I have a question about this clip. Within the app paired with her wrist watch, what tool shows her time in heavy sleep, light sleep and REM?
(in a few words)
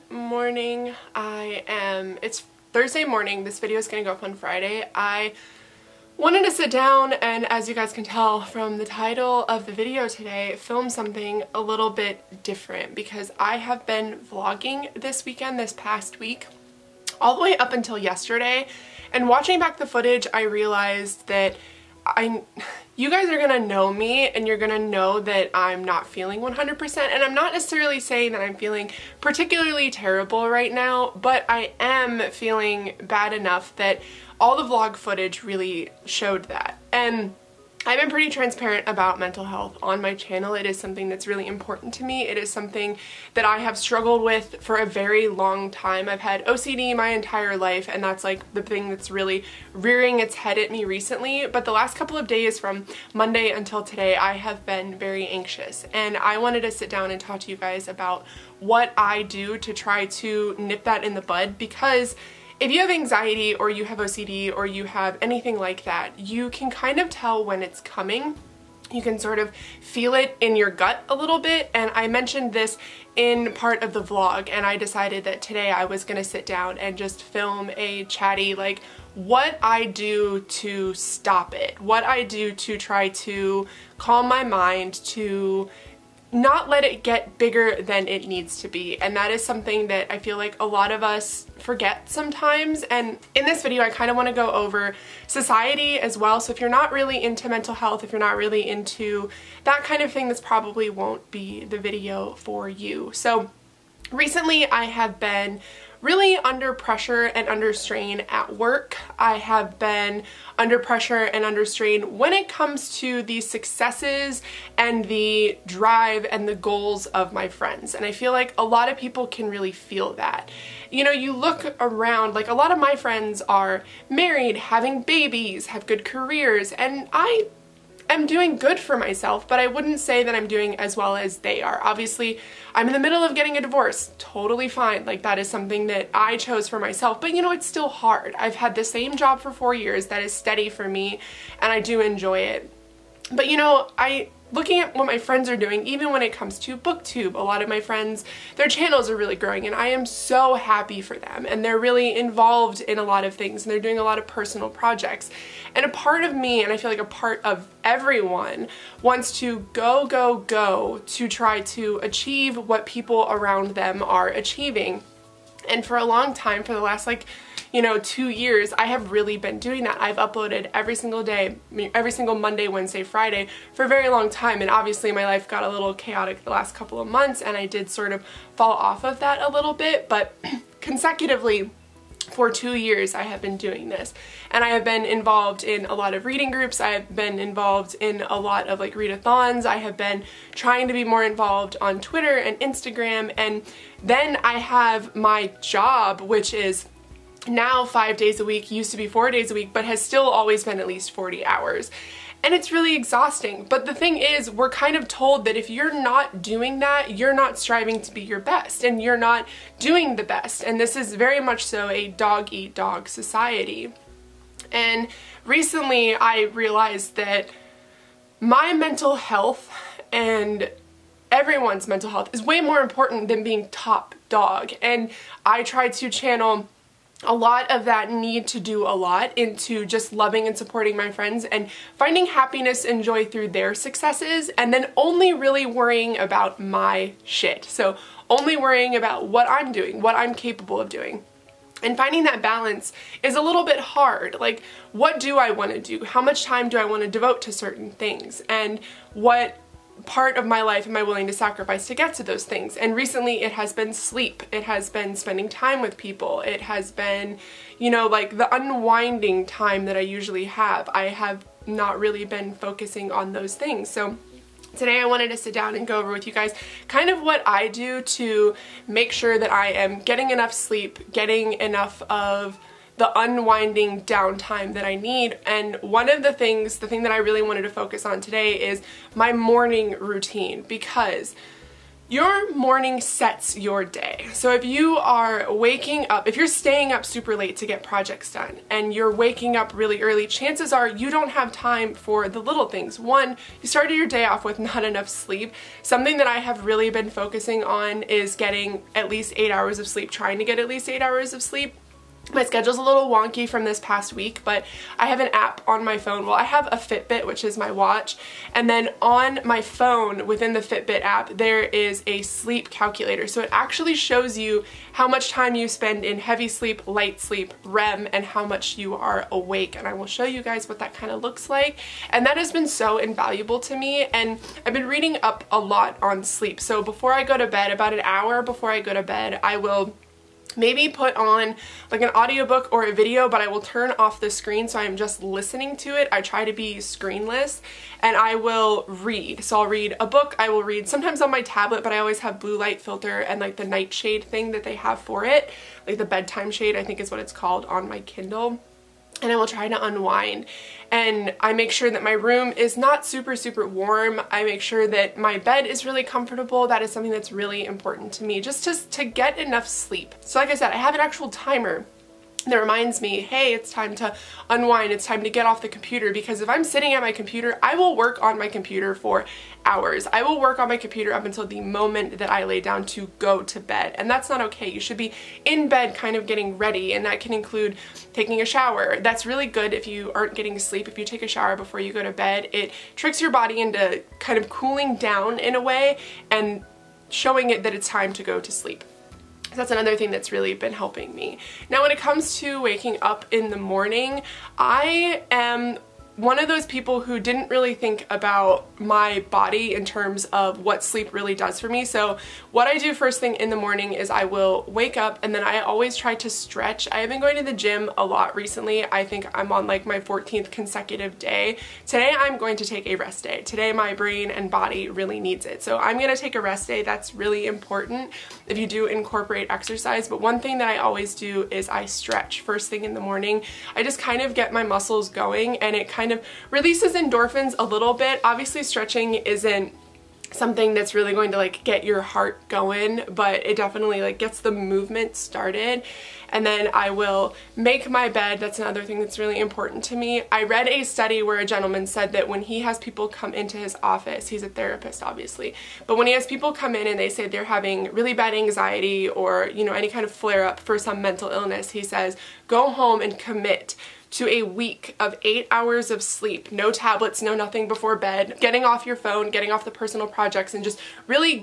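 sleep calculator.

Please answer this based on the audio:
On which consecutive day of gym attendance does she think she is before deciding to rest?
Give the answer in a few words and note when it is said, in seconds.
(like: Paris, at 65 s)
14th, at 410 s.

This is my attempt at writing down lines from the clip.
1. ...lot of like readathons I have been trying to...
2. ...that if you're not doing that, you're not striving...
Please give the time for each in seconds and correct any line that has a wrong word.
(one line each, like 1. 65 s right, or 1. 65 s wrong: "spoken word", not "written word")
1. 188 s right
2. 205 s right.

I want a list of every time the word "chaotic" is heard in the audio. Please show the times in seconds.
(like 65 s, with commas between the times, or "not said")
175 s.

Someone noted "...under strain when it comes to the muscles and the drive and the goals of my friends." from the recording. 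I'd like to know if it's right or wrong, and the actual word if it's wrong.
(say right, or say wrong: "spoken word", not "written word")
wrong: "successes", not "muscles".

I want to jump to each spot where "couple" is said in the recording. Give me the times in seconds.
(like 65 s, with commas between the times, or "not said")
51 s, 176 s.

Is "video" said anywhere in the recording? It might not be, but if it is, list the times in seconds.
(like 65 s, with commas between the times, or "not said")
3 s, 9 s, 93 s, 101 s, 332 s.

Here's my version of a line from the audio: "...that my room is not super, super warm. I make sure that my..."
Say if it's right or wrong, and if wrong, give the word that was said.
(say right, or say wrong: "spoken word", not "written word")
right.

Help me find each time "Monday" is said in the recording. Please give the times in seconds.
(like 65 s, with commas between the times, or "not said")
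53 s, 172 s.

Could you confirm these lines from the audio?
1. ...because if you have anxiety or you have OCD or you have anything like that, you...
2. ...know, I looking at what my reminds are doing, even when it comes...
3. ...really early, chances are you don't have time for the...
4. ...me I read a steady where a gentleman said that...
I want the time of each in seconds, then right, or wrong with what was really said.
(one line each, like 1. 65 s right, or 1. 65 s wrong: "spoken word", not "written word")
1. 61 s right
2. 143 s wrong: "friends", not "reminds"
3. 289 s right
4. 439 s wrong: "study", not "steady".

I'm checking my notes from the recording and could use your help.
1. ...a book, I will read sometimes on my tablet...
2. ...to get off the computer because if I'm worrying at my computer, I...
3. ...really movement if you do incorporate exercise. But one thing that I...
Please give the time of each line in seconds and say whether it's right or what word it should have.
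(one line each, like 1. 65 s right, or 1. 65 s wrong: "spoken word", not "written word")
1. 339 s right
2. 365 s wrong: "sitting", not "worrying"
3. 417 s wrong: "important", not "movement".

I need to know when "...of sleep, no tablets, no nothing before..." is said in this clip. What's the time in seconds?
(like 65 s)
455 s.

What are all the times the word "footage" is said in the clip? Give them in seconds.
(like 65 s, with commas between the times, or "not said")
19 s, 34 s.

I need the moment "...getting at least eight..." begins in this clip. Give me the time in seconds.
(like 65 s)
298 s.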